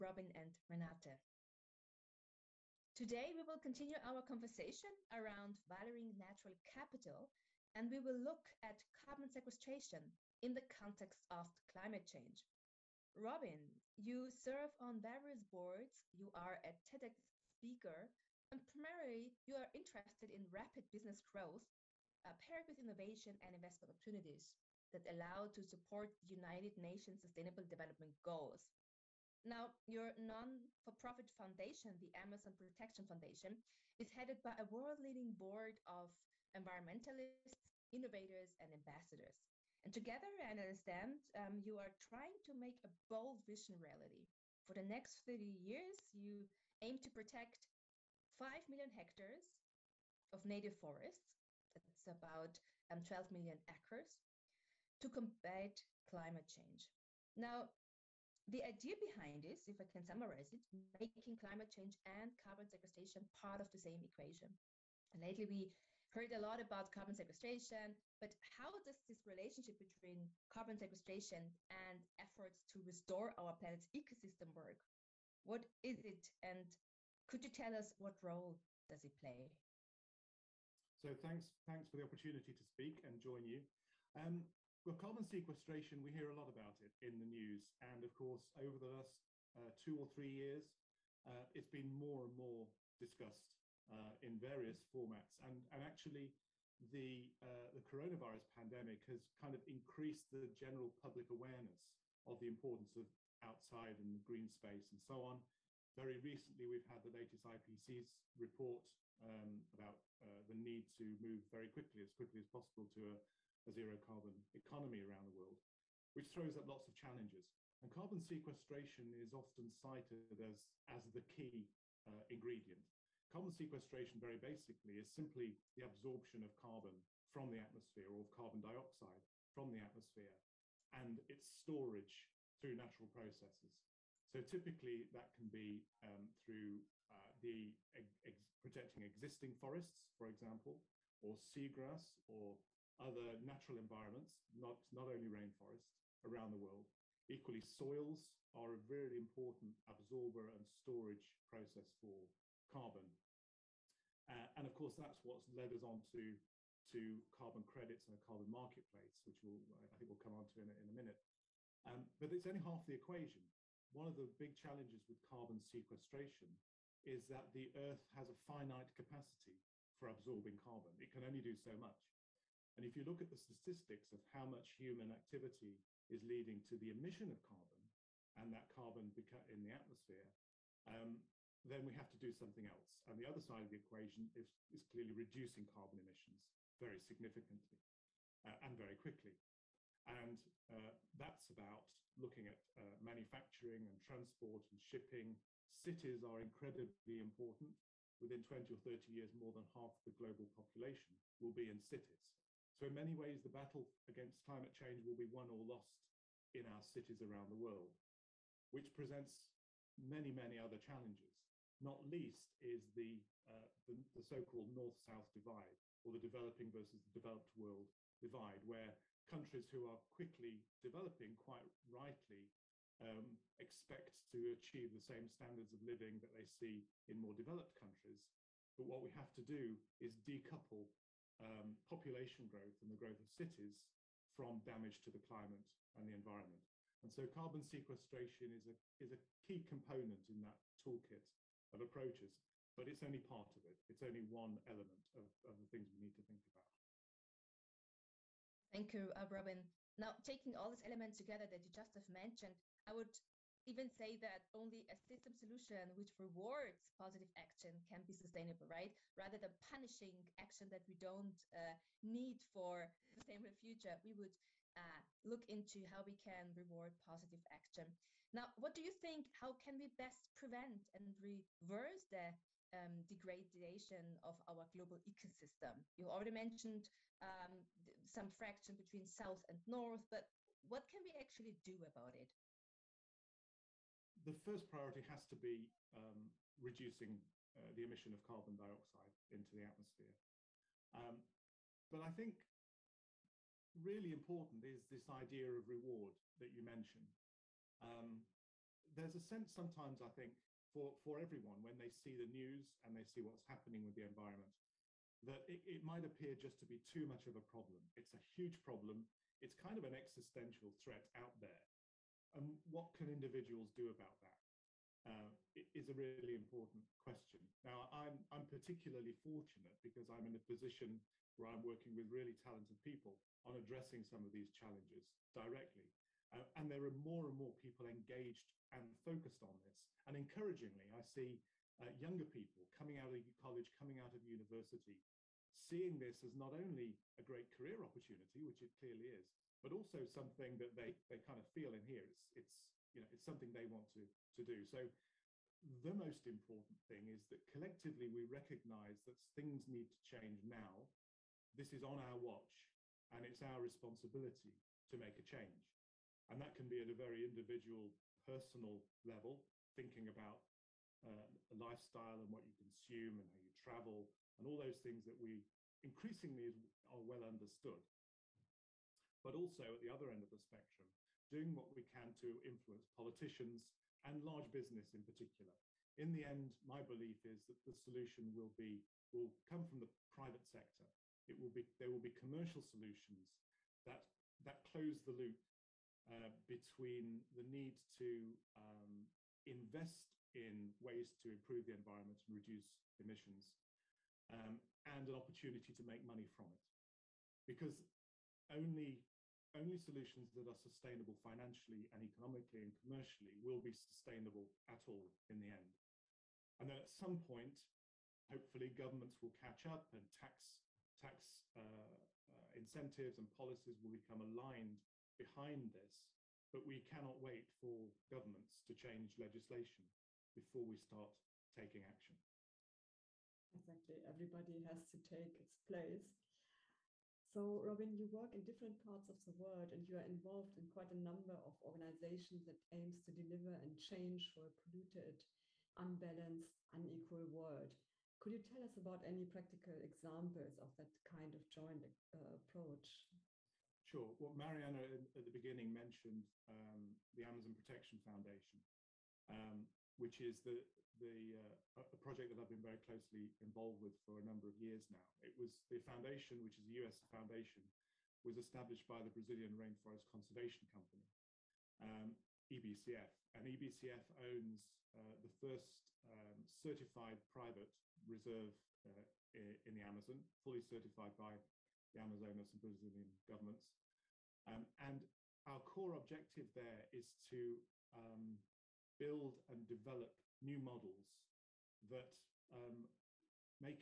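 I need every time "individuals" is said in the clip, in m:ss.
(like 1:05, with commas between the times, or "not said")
5:13, 5:57.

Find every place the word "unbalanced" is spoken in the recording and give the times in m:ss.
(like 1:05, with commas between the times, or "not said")
7:15.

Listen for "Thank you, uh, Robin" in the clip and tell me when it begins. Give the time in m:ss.
4:08.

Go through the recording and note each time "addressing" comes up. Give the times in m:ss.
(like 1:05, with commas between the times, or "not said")
5:23.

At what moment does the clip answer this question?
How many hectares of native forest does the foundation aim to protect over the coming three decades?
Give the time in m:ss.
0:48.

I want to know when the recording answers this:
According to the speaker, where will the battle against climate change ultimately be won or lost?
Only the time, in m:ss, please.
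3:26.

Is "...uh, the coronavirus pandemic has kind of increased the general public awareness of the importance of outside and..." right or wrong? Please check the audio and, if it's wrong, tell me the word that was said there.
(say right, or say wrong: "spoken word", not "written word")
right.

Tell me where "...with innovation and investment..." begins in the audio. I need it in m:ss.
0:22.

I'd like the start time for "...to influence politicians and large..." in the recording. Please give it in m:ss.
6:12.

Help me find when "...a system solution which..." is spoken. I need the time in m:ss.
4:14.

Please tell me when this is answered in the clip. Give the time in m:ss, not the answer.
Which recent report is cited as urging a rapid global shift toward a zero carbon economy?
1:47.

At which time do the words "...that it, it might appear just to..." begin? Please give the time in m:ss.
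5:05.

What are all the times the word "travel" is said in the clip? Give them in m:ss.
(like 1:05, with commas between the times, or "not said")
6:03.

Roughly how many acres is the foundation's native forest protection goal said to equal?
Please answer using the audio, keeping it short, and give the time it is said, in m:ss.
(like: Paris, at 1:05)
12 million acres, at 0:53.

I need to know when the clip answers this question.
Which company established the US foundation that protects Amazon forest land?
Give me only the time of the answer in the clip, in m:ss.
7:39.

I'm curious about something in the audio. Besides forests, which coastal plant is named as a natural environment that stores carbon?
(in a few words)
Seagrass.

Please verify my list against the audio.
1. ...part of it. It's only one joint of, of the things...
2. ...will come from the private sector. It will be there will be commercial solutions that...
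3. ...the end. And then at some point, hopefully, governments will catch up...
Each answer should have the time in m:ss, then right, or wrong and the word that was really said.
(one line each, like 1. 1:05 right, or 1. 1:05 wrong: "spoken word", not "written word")
1. 4:03 wrong: "element", not "joint"
2. 6:19 right
3. 6:45 right.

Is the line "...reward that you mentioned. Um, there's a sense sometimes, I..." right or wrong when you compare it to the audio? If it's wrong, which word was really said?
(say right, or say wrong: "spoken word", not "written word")
right.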